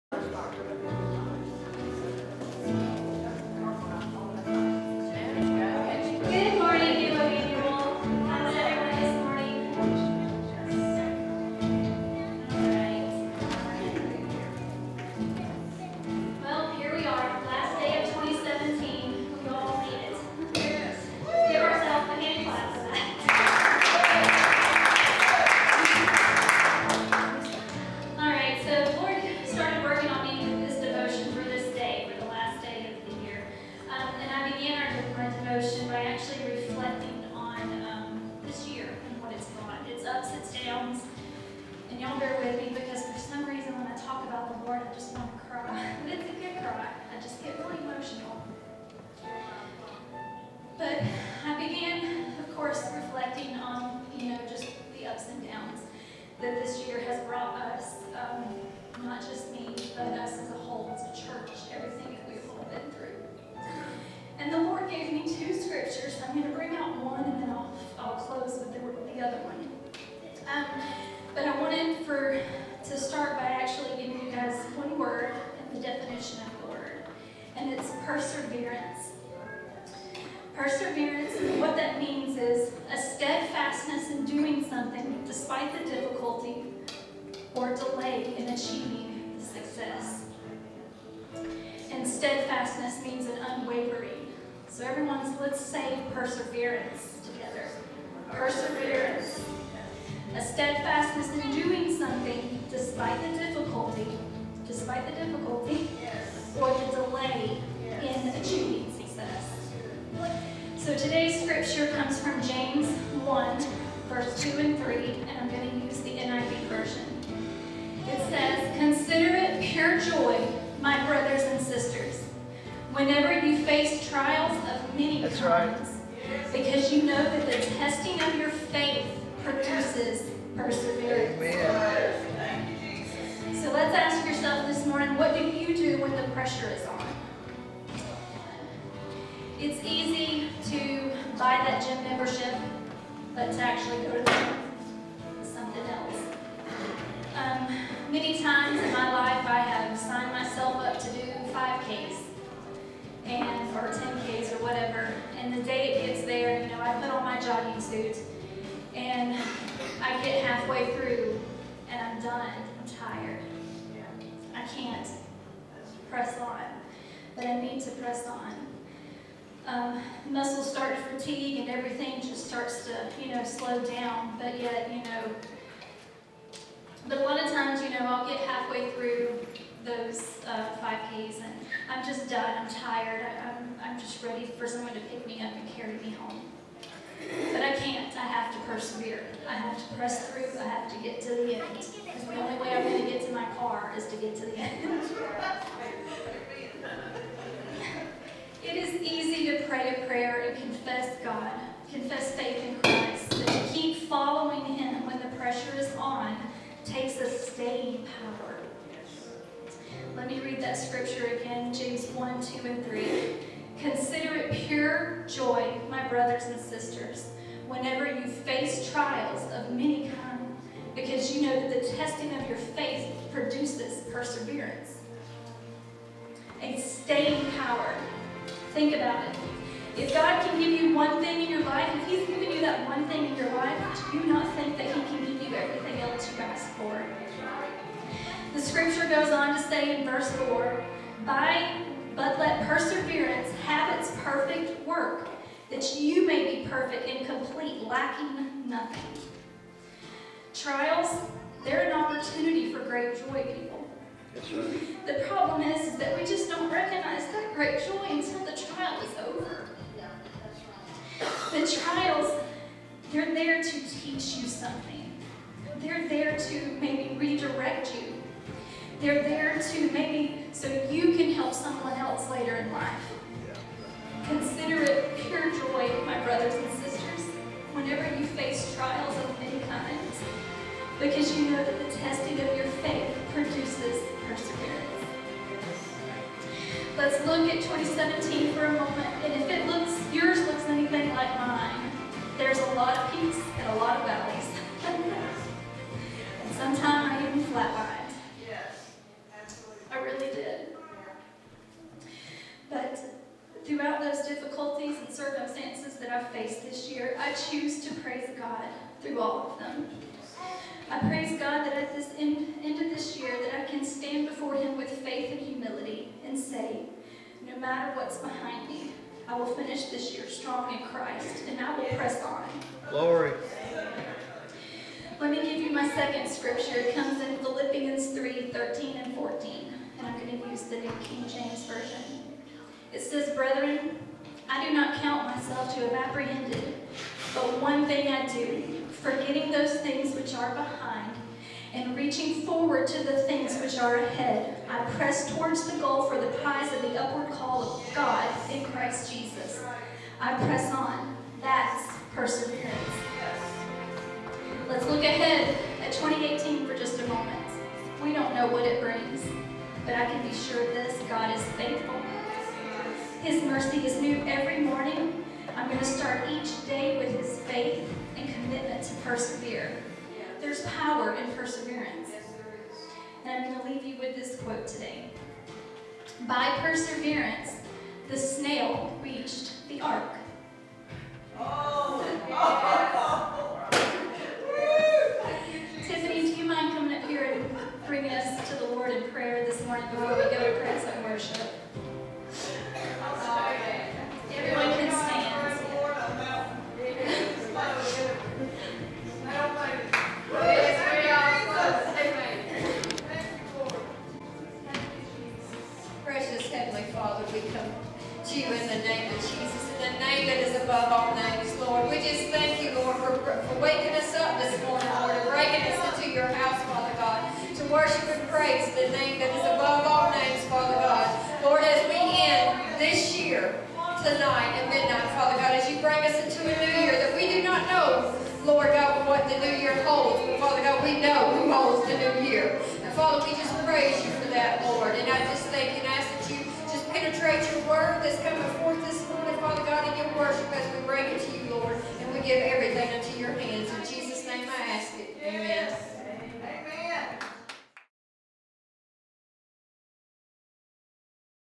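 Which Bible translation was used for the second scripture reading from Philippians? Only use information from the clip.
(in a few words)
New King James Version.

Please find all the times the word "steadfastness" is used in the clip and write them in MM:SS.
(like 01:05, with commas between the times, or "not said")
01:32, 01:40.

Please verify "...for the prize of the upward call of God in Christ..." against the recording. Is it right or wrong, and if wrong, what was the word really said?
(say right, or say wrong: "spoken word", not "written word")
right.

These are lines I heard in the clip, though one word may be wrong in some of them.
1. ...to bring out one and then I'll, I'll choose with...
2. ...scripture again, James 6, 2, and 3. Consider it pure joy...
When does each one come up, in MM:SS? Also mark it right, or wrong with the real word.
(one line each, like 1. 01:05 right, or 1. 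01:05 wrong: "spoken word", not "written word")
1. 01:06 wrong: "close", not "choose"
2. 03:30 wrong: "1", not "6".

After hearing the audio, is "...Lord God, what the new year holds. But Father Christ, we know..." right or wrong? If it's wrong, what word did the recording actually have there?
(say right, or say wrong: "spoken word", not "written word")
wrong: "God", not "Christ".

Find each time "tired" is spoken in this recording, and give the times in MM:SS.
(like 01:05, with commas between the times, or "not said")
02:42, 03:02.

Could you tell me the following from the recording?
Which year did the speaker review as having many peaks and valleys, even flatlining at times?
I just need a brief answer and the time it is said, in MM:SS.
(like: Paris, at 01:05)
2017, at 04:47.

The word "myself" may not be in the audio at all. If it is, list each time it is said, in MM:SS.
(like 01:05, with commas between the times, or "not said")
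02:30, 05:35.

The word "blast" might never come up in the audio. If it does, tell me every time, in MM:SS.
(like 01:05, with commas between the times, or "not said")
not said.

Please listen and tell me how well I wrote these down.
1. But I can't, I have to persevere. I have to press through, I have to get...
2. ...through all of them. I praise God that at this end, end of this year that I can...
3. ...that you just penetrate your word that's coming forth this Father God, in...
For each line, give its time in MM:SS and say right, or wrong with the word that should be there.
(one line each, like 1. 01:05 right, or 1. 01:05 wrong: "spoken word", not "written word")
1. 03:07 right
2. 05:09 right
3. 07:16 right.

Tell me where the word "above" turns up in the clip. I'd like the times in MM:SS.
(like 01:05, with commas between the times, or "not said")
06:50, 06:59.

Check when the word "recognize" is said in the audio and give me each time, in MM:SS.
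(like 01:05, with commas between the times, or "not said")
04:16.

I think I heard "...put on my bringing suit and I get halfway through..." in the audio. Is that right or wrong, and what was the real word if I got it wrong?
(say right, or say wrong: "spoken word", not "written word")
wrong: "jogging", not "bringing".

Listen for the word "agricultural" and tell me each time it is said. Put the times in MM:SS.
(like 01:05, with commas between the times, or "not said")
not said.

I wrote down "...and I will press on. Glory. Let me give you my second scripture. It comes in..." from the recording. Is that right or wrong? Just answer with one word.
right.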